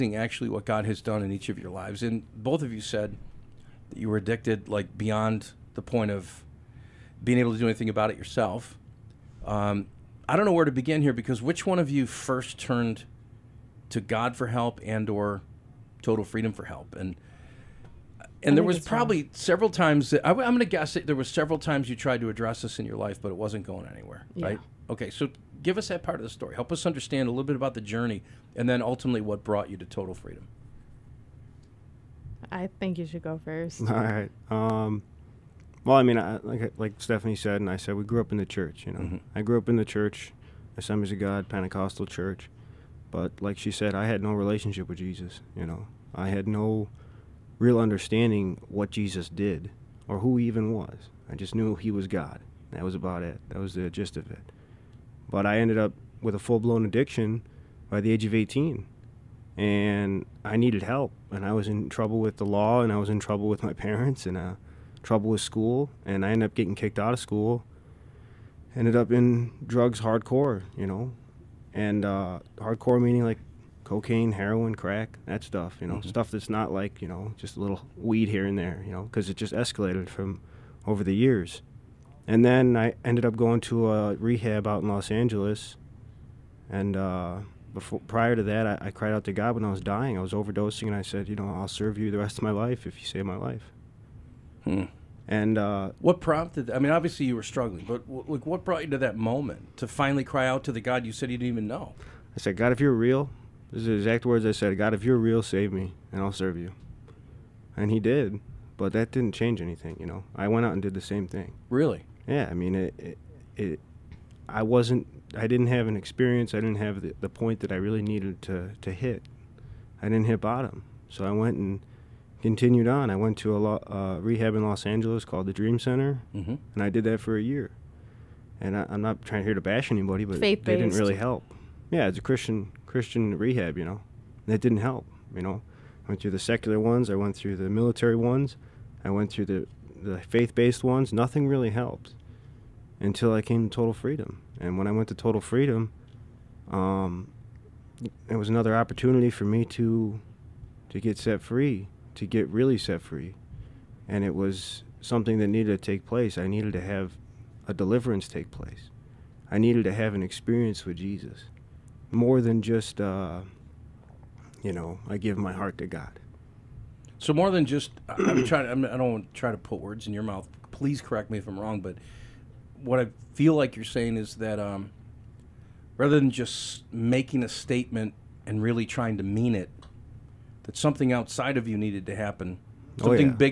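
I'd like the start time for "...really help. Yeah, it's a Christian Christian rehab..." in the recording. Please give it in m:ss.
2:10.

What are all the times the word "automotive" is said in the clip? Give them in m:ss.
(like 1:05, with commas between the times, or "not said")
not said.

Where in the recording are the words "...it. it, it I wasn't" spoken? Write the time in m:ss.
1:52.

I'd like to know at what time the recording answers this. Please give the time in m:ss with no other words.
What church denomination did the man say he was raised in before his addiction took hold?
0:40.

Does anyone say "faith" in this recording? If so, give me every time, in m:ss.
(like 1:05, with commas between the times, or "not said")
2:10, 2:20.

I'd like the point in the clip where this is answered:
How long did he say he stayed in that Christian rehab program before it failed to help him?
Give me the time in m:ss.
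2:07.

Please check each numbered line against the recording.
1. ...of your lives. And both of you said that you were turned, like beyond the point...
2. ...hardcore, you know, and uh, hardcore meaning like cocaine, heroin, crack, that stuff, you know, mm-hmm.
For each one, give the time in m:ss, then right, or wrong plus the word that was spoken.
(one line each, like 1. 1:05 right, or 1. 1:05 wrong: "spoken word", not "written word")
1. 0:01 wrong: "addicted", not "turned"
2. 1:10 right.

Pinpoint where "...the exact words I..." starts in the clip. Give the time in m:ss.
1:43.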